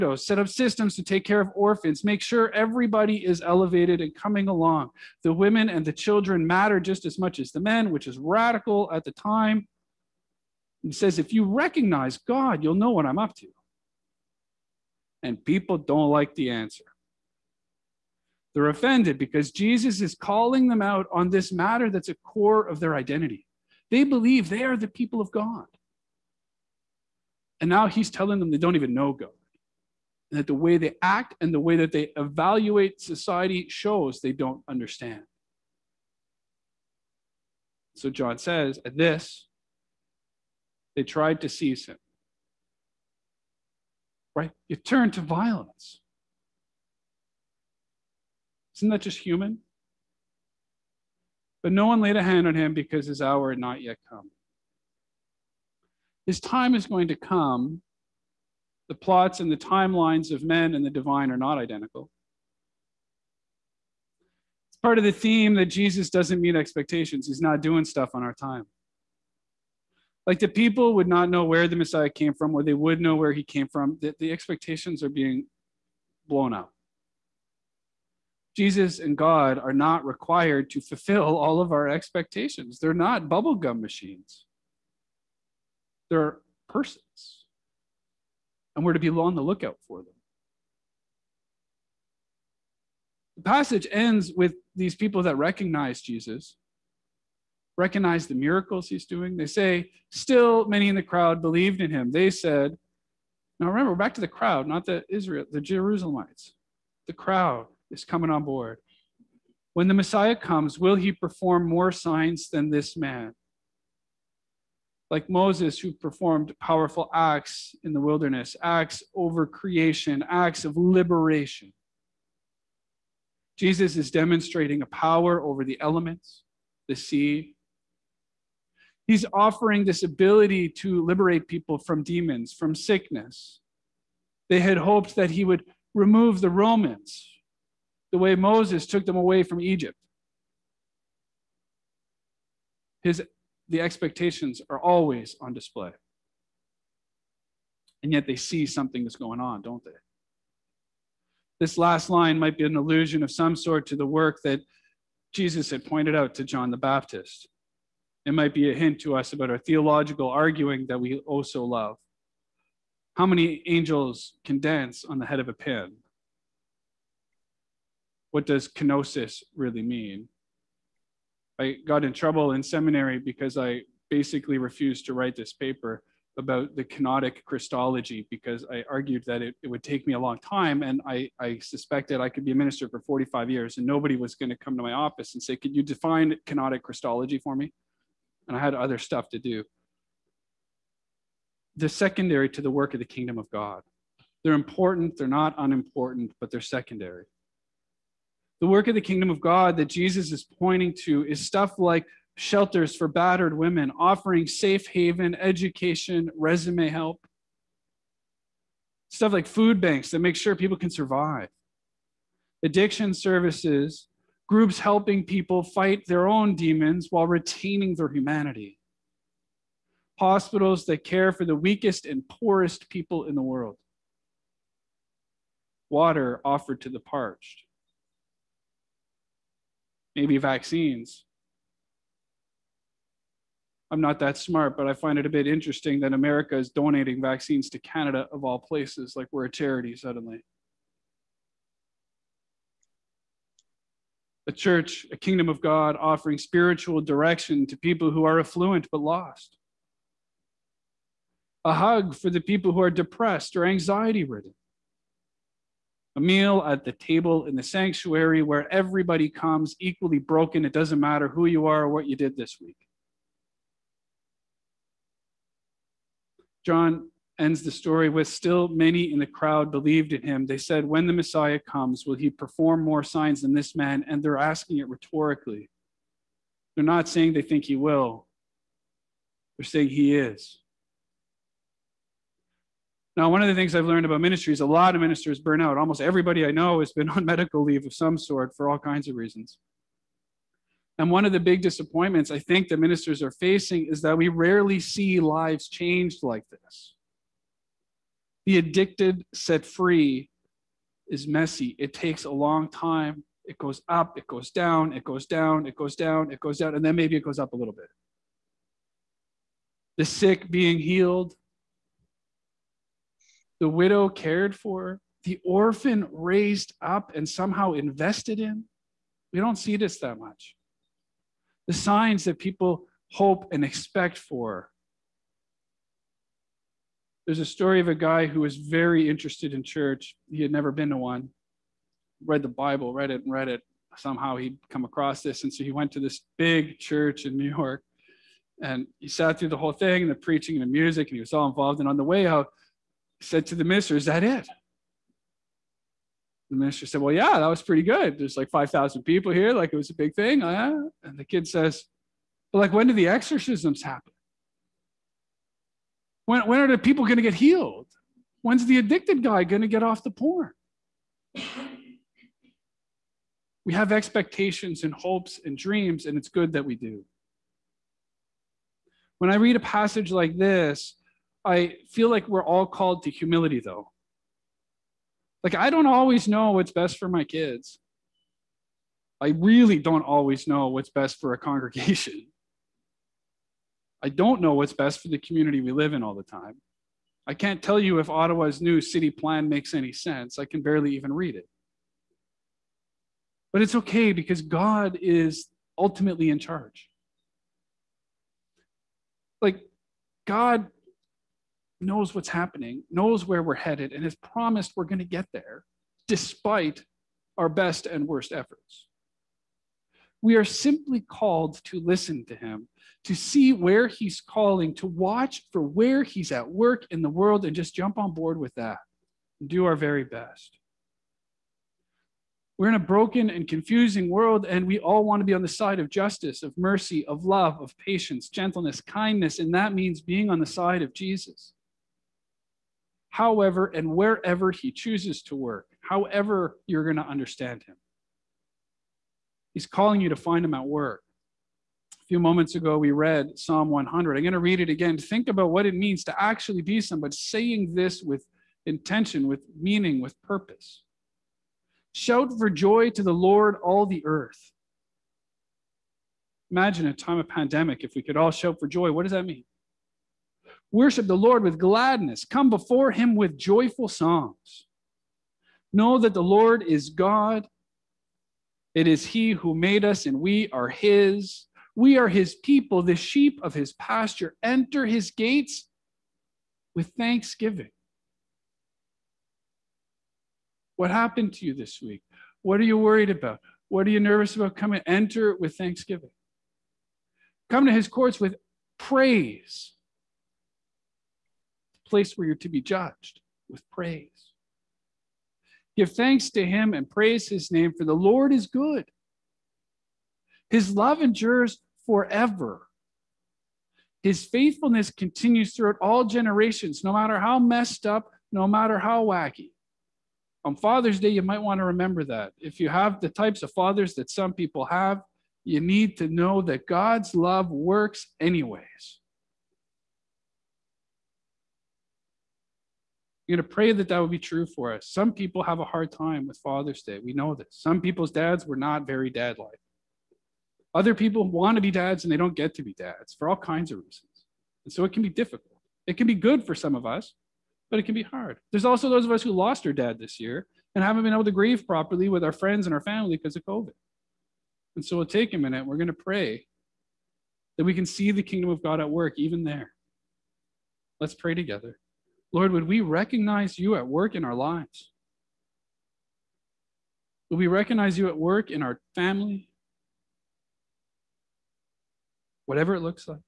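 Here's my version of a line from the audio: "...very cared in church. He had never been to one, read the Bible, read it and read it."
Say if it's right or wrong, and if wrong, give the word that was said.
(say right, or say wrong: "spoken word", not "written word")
wrong: "interested", not "cared".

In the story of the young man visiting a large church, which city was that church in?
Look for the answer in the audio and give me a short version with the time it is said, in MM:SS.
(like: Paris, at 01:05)
New York, at 05:37.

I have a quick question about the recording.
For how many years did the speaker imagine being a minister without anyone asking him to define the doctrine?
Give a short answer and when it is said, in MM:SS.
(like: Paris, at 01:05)
45, at 03:02.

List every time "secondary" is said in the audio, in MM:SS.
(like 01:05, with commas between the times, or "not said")
03:11, 03:16.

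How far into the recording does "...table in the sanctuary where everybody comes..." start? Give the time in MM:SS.
04:16.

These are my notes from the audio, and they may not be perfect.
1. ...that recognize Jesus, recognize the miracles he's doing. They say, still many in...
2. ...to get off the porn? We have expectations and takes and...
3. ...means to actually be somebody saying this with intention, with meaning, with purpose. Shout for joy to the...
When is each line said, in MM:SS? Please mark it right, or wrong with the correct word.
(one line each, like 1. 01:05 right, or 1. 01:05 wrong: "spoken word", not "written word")
1. 01:35 right
2. 05:59 wrong: "hopes", not "takes"
3. 07:25 right.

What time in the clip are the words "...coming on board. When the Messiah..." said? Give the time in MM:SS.
01:48.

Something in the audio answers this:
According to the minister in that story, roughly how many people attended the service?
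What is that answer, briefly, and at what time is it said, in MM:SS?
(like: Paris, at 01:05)
5,000, at 05:48.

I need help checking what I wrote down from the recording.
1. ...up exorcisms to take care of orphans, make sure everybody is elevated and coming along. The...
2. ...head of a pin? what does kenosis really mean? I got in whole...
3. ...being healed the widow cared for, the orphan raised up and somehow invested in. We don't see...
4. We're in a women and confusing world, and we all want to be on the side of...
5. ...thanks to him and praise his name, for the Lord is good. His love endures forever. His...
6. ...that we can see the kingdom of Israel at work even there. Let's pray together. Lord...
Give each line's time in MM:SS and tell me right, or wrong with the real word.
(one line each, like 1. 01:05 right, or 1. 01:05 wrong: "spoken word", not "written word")
1. 00:00 wrong: "systems", not "exorcisms"
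2. 02:45 wrong: "trouble", not "whole"
3. 05:10 right
4. 07:02 wrong: "broken", not "women"
5. 08:15 right
6. 09:07 wrong: "God", not "Israel".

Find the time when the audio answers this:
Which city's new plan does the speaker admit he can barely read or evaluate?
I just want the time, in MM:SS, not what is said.
06:28.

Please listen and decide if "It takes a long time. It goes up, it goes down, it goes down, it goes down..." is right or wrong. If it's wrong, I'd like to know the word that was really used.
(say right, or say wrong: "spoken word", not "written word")
right.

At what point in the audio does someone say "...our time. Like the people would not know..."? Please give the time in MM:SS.
01:08.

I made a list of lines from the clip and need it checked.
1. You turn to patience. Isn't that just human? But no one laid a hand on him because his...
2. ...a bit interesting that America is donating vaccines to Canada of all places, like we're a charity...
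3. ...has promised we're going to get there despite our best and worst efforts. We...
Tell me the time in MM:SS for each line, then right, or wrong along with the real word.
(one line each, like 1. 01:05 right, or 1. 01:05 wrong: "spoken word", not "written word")
1. 00:44 wrong: "violence", not "patience"
2. 03:55 right
3. 06:44 right.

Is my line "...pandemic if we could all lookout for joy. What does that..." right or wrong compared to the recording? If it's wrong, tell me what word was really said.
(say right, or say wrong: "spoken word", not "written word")
wrong: "shout", not "lookout".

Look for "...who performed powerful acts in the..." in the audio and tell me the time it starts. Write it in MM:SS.
01:55.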